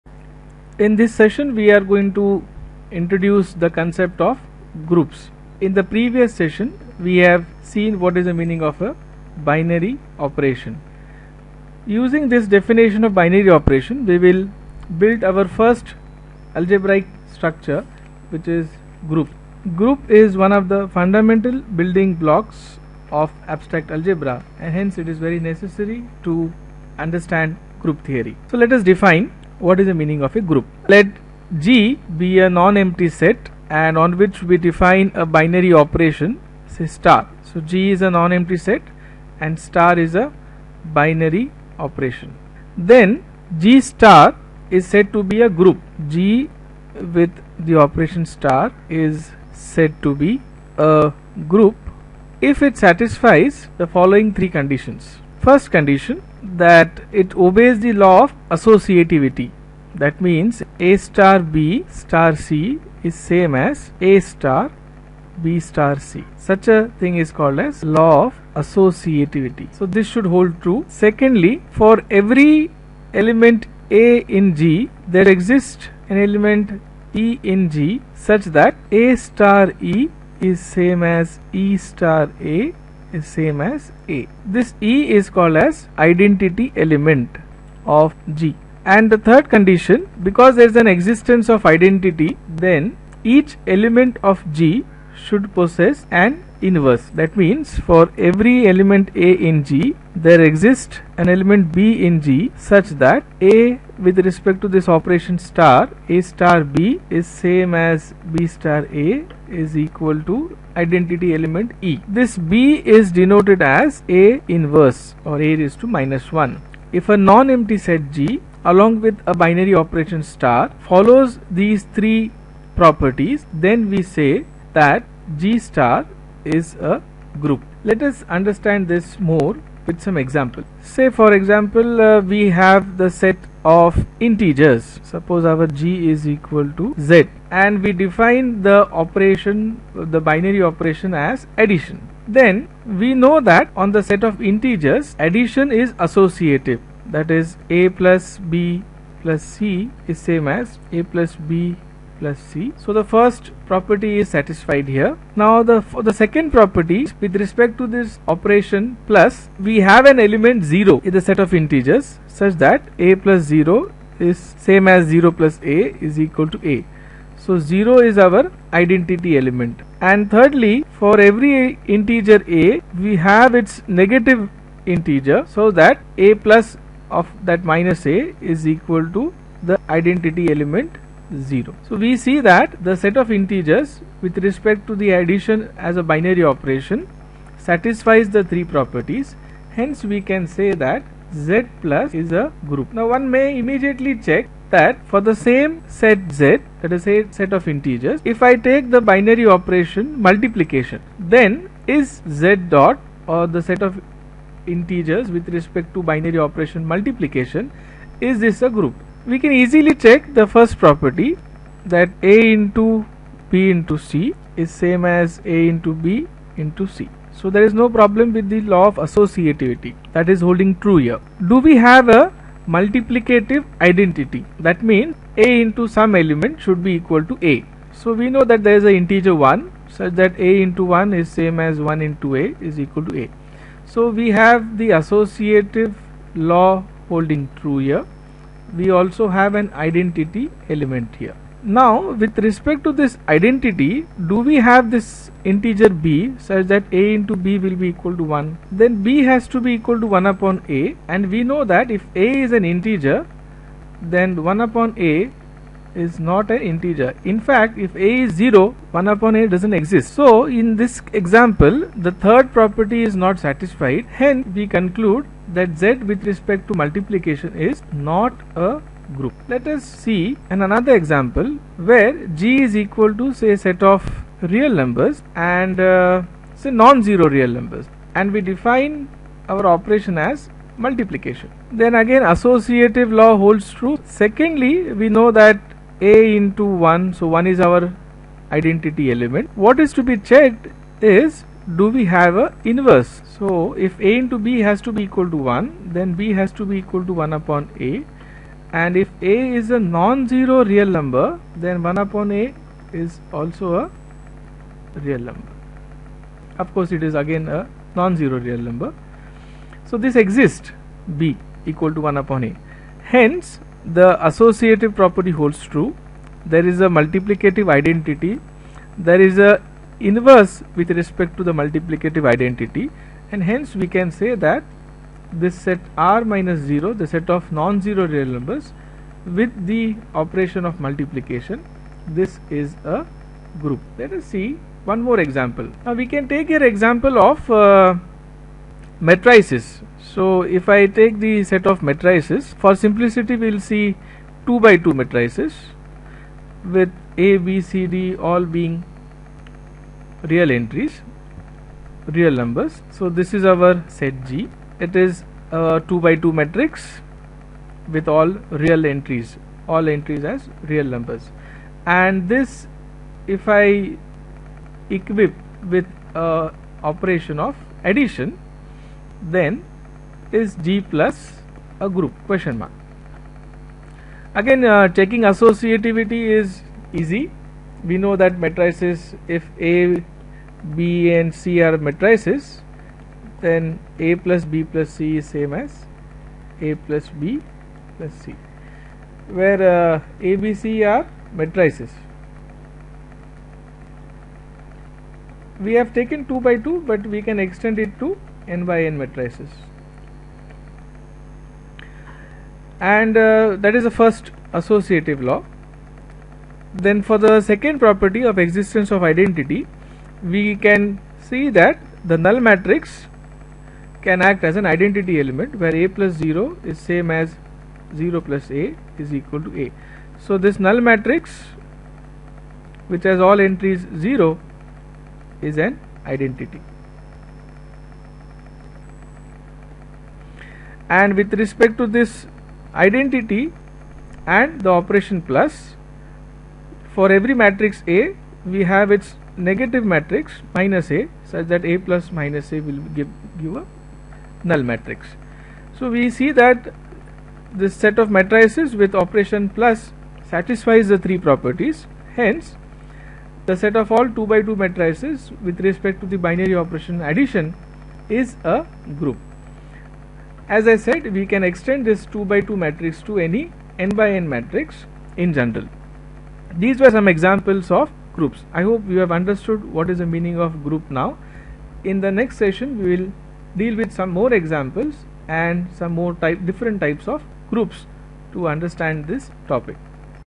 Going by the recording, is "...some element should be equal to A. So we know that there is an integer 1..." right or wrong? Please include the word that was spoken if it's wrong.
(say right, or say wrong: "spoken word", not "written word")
right.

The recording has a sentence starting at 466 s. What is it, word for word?
These were some examples of groups.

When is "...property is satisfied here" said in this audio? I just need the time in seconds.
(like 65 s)
153 s.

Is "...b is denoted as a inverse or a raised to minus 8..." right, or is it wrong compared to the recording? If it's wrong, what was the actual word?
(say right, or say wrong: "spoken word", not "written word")
wrong: "1", not "8".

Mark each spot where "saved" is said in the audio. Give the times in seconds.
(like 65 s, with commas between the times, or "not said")
not said.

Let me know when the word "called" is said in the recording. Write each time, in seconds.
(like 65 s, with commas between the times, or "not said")
67 s, 85 s.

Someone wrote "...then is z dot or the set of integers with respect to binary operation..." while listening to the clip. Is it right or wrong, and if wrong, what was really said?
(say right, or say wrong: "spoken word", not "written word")
right.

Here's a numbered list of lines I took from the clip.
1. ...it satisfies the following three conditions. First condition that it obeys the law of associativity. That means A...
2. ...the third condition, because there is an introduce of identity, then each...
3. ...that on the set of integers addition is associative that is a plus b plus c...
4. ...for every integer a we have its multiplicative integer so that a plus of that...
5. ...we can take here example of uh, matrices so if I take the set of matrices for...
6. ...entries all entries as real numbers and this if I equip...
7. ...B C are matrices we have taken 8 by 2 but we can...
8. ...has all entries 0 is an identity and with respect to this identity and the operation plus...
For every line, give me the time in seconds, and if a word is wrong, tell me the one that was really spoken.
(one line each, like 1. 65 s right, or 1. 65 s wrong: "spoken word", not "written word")
1. 52 s right
2. 89 s wrong: "existence", not "introduce"
3. 143 s right
4. 171 s wrong: "negative", not "multiplicative"
5. 335 s right
6. 358 s right
7. 390 s wrong: "2", not "8"
8. 423 s right.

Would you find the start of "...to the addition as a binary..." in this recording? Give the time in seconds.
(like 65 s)
184 s.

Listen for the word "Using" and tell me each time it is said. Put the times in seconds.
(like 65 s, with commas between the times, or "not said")
11 s.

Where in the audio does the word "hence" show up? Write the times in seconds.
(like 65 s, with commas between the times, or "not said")
24 s, 189 s, 264 s, 313 s, 323 s, 452 s.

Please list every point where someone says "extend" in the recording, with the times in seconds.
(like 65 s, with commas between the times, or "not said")
397 s, 461 s.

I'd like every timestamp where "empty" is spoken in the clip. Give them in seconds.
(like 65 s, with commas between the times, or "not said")
32 s, 38 s, 117 s.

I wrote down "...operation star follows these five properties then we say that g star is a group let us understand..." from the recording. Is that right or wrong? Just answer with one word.
wrong.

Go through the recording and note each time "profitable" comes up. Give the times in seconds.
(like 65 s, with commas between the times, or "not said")
not said.